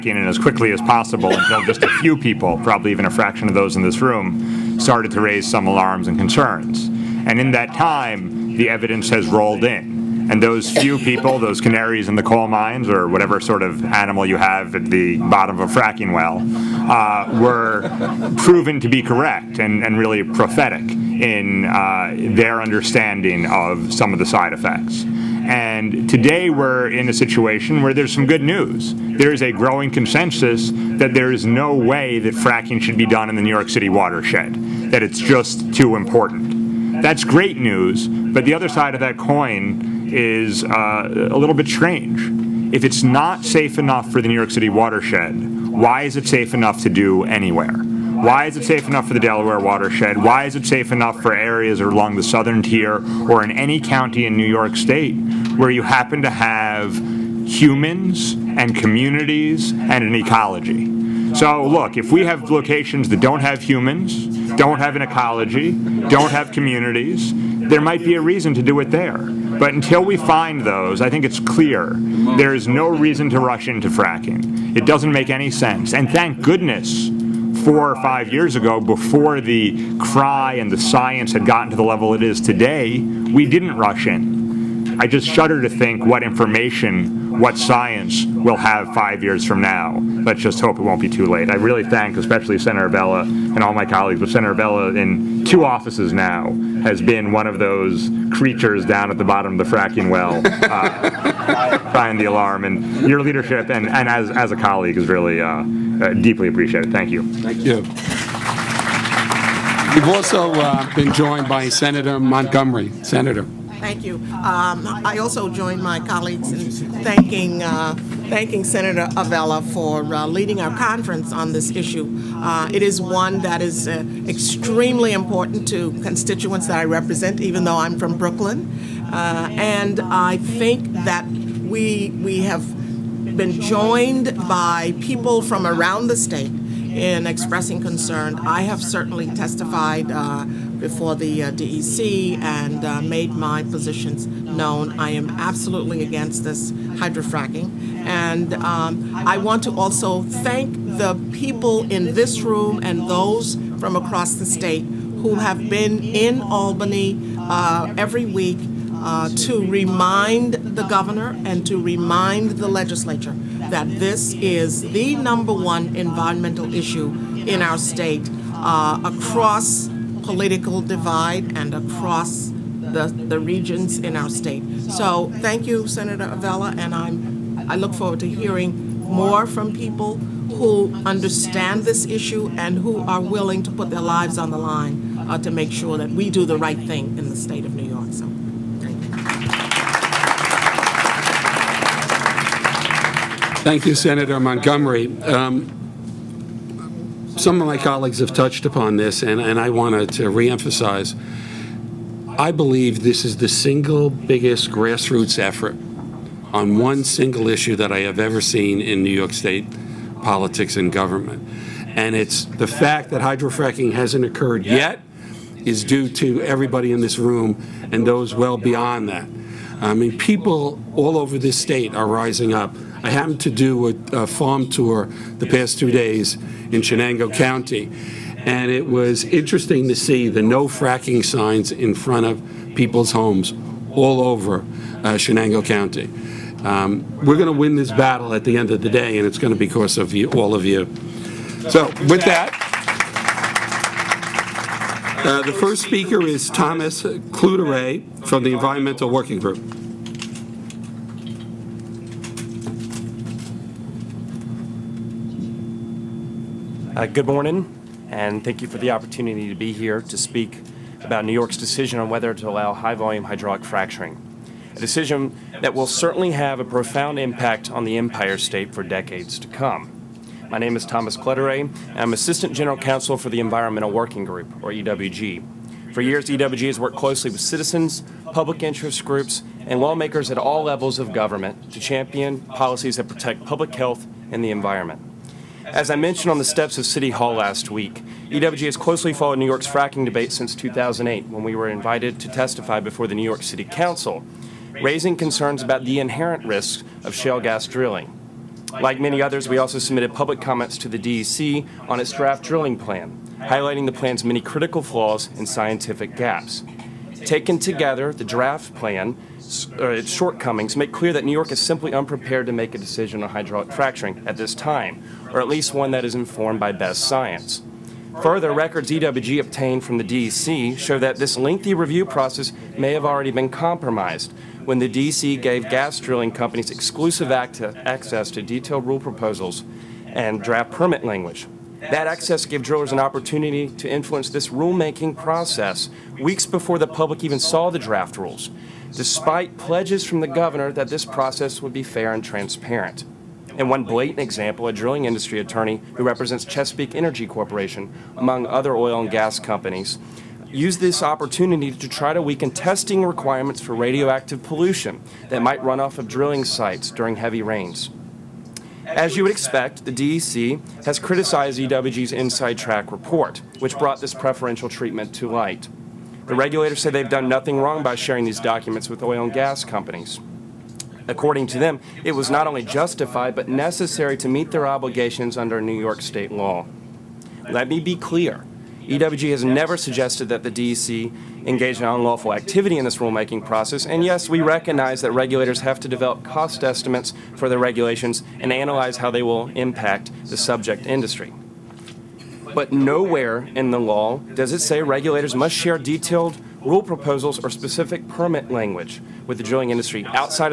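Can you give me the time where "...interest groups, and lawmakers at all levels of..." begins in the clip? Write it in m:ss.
4:38.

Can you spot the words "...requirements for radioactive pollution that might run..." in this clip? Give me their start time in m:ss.
5:53.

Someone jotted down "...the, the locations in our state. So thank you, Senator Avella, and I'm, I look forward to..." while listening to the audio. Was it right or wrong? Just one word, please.
wrong.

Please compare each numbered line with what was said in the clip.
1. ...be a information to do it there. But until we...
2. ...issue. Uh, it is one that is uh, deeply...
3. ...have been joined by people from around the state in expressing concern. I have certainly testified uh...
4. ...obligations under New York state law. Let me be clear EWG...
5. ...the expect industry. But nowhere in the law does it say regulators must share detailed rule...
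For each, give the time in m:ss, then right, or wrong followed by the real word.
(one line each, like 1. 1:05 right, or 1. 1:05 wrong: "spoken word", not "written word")
1. 1:08 wrong: "reason", not "information"
2. 2:01 wrong: "extremely", not "deeply"
3. 2:12 right
4. 6:14 right
5. 6:30 wrong: "subject", not "expect".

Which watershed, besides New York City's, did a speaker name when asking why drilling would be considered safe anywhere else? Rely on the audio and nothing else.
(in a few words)
Delaware.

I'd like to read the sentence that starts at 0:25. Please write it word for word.
And today we're in a situation where there's some good news.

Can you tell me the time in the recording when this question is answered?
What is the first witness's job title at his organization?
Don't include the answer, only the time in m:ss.
4:32.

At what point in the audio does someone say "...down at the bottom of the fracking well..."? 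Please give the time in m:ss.
1:38.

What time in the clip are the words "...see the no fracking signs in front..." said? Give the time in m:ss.
3:49.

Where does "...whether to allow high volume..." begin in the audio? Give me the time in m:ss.
4:22.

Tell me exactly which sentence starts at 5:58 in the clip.
As you would expect, the DEC has criticized EWG's inside track report, which brought this preferential treatment to light.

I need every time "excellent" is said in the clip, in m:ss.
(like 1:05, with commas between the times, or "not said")
not said.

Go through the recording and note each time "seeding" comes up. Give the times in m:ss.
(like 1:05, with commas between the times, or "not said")
not said.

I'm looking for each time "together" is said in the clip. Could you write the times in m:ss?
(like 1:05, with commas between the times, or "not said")
5:07.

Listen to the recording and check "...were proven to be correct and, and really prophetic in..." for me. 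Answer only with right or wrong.
right.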